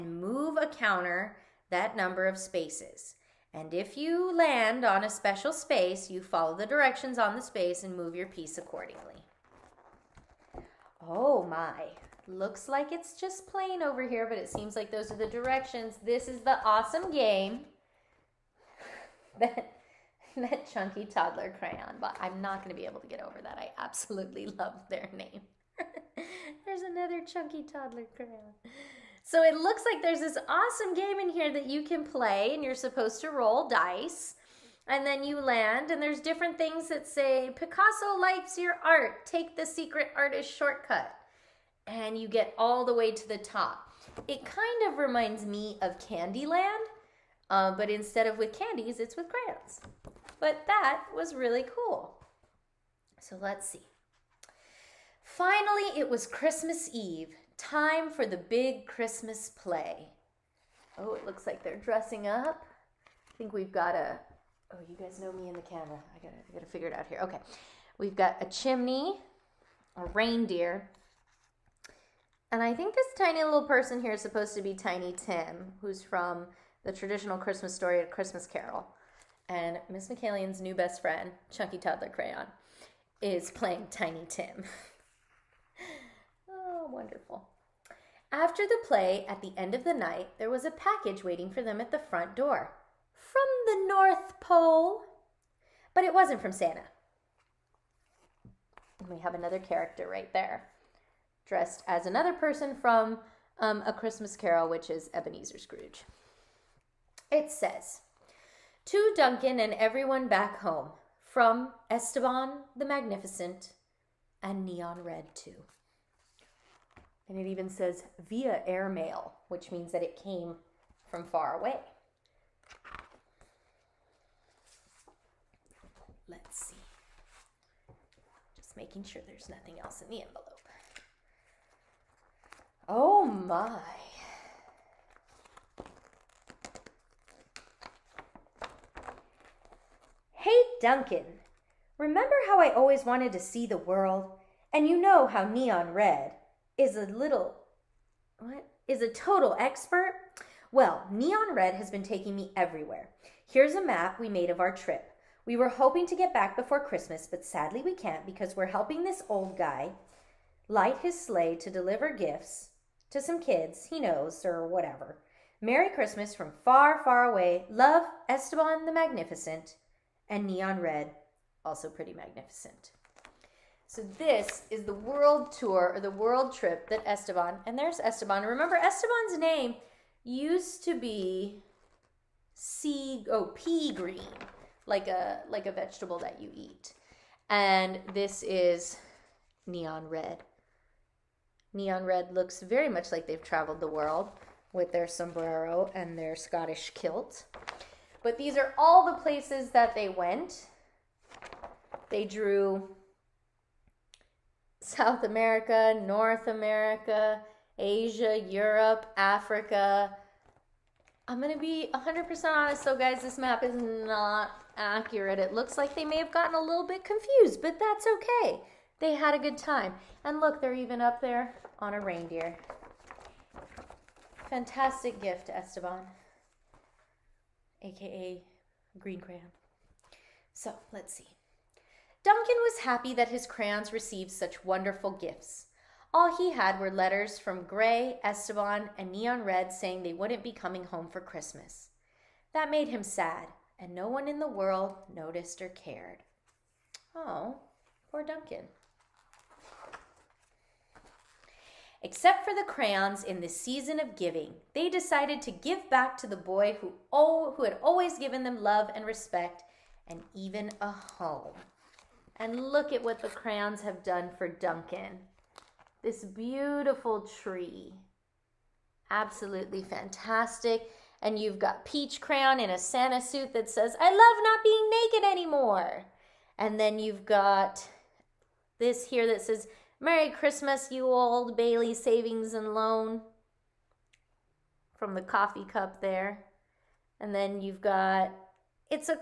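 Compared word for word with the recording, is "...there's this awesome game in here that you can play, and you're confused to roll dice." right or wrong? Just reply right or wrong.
wrong.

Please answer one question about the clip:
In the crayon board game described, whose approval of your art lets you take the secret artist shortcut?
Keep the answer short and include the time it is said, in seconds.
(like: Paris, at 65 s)
Picasso, at 37 s.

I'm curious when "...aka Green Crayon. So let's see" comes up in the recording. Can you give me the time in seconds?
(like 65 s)
227 s.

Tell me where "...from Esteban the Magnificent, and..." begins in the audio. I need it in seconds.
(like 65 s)
111 s.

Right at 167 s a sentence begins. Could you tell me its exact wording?
Love, Esteban the Magnificent, and Neon Red, also pretty magnificent.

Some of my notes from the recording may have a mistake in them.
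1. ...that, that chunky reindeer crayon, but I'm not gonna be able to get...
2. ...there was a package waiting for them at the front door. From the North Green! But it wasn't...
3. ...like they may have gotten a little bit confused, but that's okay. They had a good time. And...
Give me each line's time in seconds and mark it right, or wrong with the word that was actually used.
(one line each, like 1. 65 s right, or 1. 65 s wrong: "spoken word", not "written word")
1. 19 s wrong: "toddler", not "reindeer"
2. 90 s wrong: "Pole", not "Green"
3. 215 s right.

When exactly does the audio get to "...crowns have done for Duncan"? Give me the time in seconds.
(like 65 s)
263 s.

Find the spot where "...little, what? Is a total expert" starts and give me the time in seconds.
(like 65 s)
147 s.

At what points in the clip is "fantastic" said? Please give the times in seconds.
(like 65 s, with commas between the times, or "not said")
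224 s, 269 s.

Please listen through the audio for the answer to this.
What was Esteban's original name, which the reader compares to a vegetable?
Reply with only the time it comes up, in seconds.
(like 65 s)
183 s.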